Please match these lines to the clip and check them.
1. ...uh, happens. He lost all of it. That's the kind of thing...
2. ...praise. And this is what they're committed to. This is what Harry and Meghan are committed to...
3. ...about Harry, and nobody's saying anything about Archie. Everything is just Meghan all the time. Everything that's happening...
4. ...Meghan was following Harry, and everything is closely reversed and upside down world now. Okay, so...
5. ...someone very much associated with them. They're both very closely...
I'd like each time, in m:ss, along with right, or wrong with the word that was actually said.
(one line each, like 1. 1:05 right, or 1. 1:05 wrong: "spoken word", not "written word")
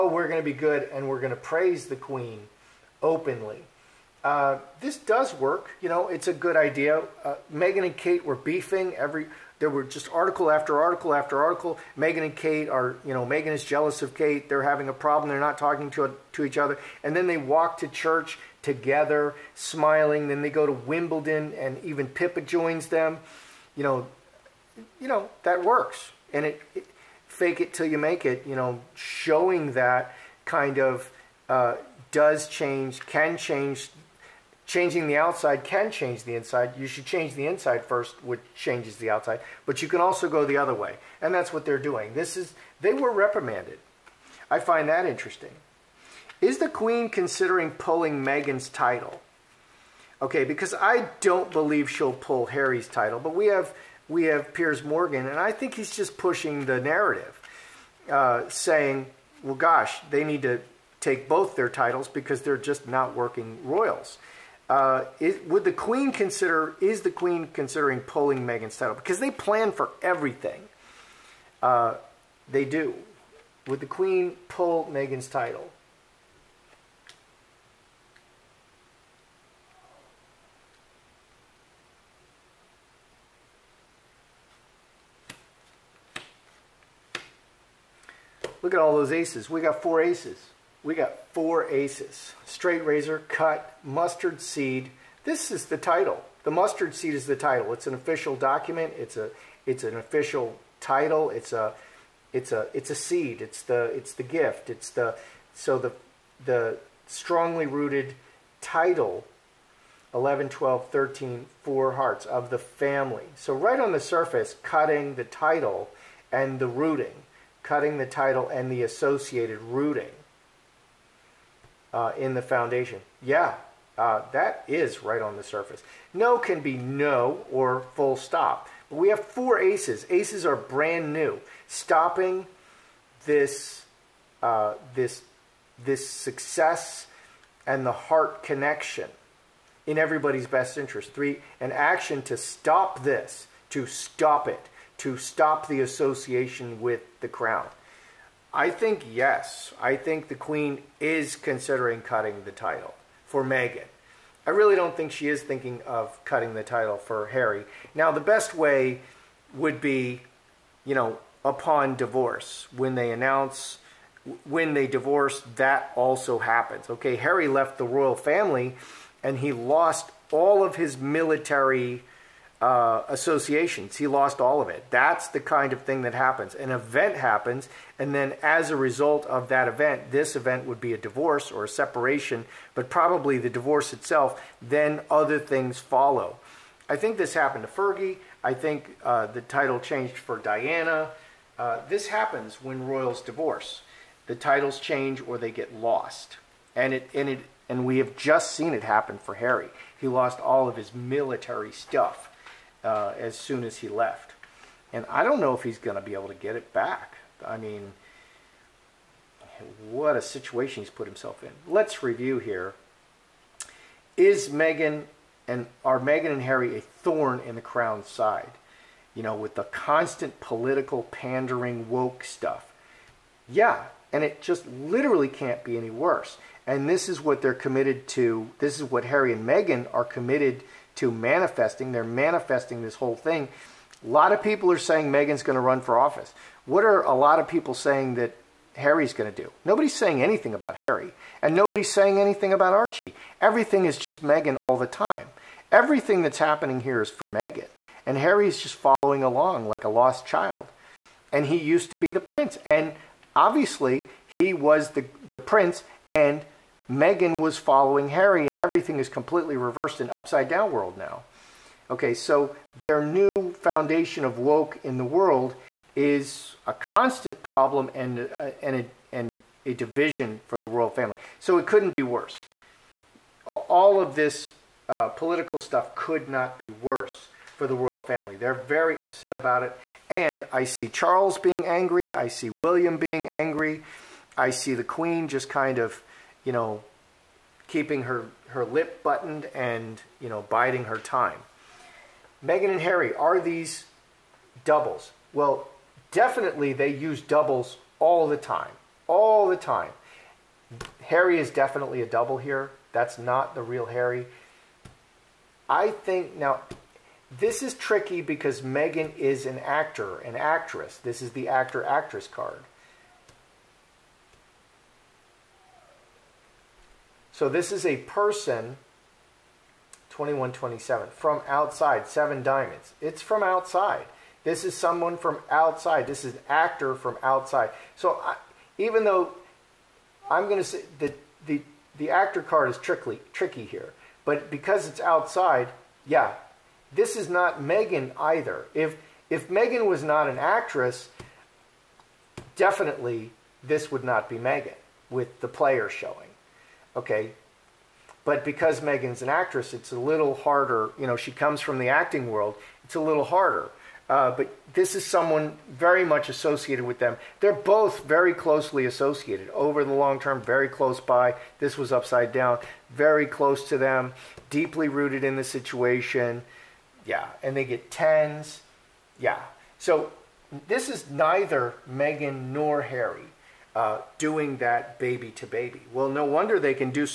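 1. 2:52 wrong: "associations", not "happens"
2. 3:45 wrong: "worse", not "praise"
3. 4:00 right
4. 4:16 wrong: "completely", not "closely"
5. 5:55 right.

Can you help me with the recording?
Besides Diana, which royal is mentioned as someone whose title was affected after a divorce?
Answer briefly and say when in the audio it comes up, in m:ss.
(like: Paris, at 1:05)
Fergie, at 3:07.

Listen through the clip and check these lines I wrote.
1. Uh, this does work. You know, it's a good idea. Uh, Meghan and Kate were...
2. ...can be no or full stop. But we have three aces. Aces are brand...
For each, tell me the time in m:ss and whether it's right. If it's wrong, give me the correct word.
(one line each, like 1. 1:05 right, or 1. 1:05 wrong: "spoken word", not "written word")
1. 0:04 right
2. 2:06 wrong: "four", not "three".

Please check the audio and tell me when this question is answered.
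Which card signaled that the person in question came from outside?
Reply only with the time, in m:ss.
5:22.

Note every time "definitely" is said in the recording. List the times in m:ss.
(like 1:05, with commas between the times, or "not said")
4:56, 5:01, 5:42.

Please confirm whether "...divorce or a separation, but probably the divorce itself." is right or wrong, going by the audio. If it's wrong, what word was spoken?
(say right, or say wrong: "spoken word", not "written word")
right.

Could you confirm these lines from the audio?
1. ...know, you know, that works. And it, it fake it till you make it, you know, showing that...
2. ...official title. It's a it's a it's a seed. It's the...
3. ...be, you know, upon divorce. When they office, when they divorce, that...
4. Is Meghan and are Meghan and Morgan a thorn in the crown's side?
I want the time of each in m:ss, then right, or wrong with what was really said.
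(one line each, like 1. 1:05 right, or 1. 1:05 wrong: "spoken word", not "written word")
1. 0:23 right
2. 1:39 right
3. 2:39 wrong: "announce", not "office"
4. 3:34 wrong: "Harry", not "Morgan".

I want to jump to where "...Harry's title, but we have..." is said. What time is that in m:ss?
0:52.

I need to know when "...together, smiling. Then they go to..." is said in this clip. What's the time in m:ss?
0:18.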